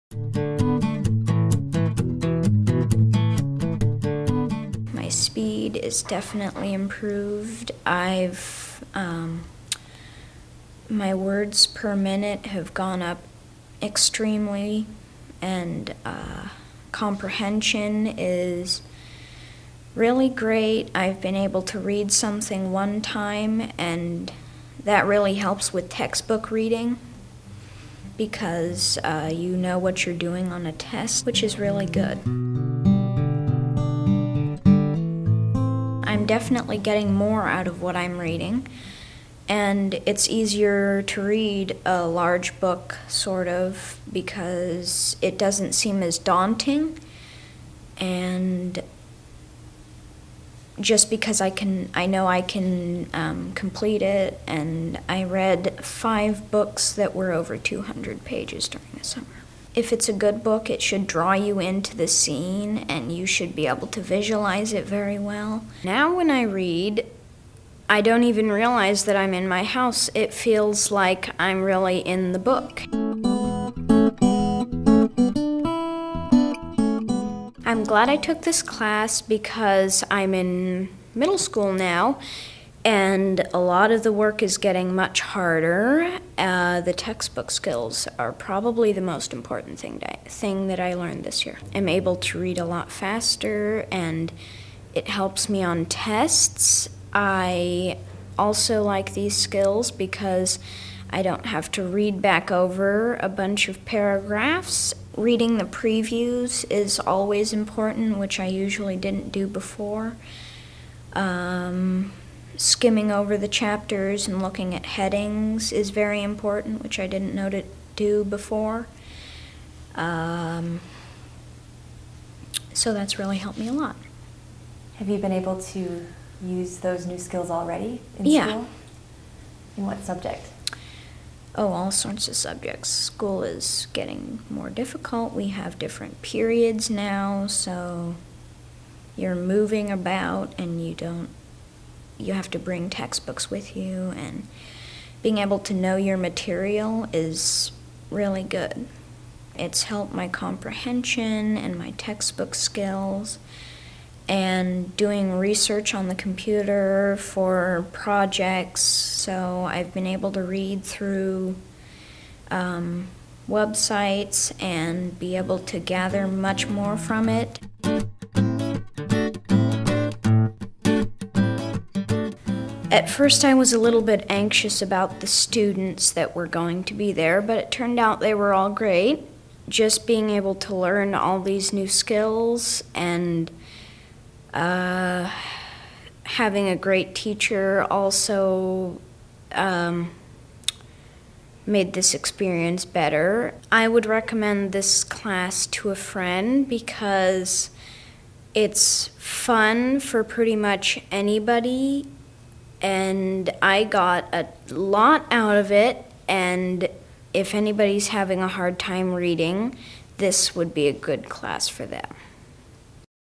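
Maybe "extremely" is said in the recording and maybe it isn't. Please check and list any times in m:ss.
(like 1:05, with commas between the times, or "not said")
0:13.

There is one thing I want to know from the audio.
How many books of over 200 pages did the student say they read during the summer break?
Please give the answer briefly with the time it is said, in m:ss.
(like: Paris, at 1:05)
5, at 0:55.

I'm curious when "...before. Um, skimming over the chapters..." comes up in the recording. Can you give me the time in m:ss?
1:49.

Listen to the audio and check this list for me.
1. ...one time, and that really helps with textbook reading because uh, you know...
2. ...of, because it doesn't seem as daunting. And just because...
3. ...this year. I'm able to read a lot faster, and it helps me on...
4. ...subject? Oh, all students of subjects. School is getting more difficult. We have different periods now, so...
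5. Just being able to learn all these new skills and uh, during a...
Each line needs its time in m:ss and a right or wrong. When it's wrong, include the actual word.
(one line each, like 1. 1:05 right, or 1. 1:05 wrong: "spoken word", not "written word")
1. 0:22 right
2. 0:43 right
3. 1:31 right
4. 2:10 wrong: "sorts", not "students"
5. 2:59 wrong: "having", not "during".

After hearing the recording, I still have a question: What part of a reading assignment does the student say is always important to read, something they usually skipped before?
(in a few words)
previews.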